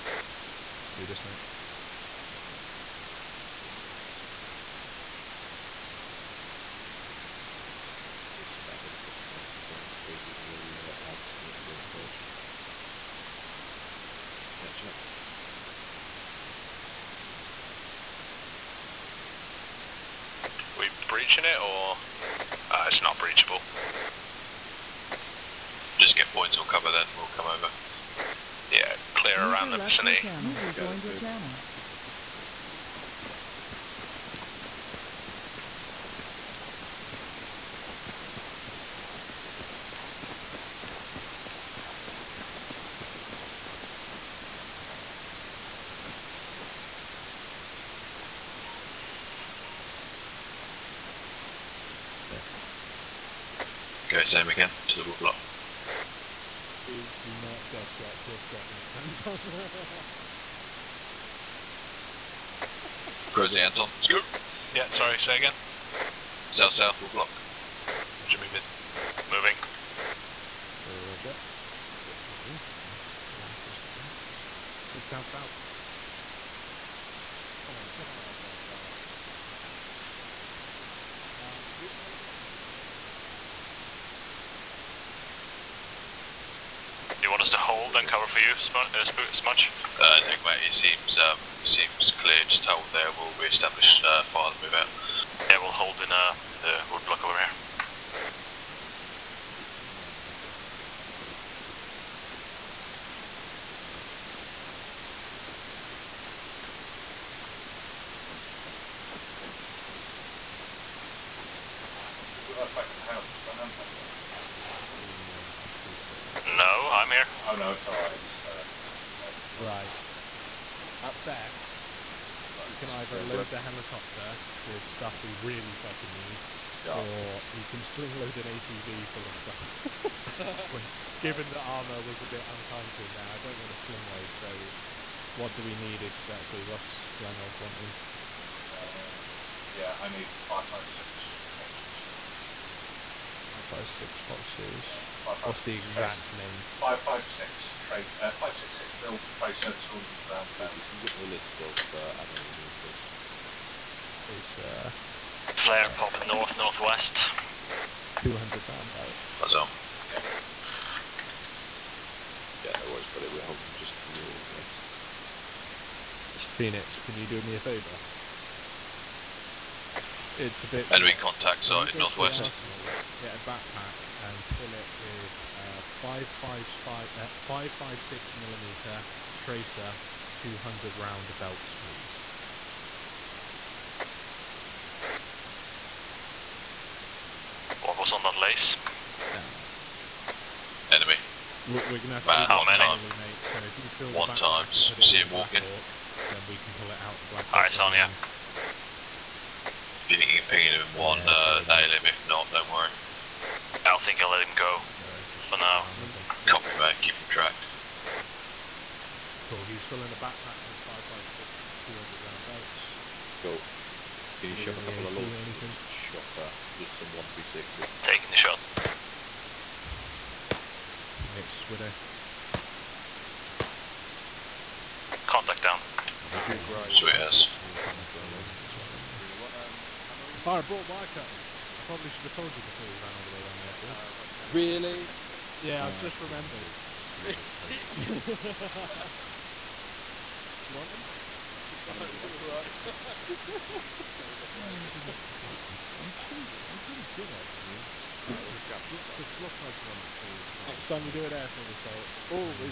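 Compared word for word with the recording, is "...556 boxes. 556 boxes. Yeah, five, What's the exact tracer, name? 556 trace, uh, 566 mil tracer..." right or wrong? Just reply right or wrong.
right.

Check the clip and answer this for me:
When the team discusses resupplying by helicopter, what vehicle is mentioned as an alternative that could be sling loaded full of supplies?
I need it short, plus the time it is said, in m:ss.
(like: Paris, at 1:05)
ATV, at 2:08.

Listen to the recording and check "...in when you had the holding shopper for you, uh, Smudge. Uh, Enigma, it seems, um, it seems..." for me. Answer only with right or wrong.
wrong.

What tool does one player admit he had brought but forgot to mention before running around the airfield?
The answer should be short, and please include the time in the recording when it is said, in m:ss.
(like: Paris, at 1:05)
Wire cutters, at 3:50.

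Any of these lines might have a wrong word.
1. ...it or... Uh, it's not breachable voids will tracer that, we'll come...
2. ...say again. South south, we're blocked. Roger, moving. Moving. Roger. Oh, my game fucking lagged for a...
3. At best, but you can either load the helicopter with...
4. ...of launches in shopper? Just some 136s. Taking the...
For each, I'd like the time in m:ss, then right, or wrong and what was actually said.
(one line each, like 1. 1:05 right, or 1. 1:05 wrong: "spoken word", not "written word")
1. 0:21 wrong: "cover", not "tracer"
2. 1:05 right
3. 2:01 right
4. 3:35 right.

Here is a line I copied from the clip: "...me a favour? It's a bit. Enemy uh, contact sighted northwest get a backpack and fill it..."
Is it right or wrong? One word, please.
right.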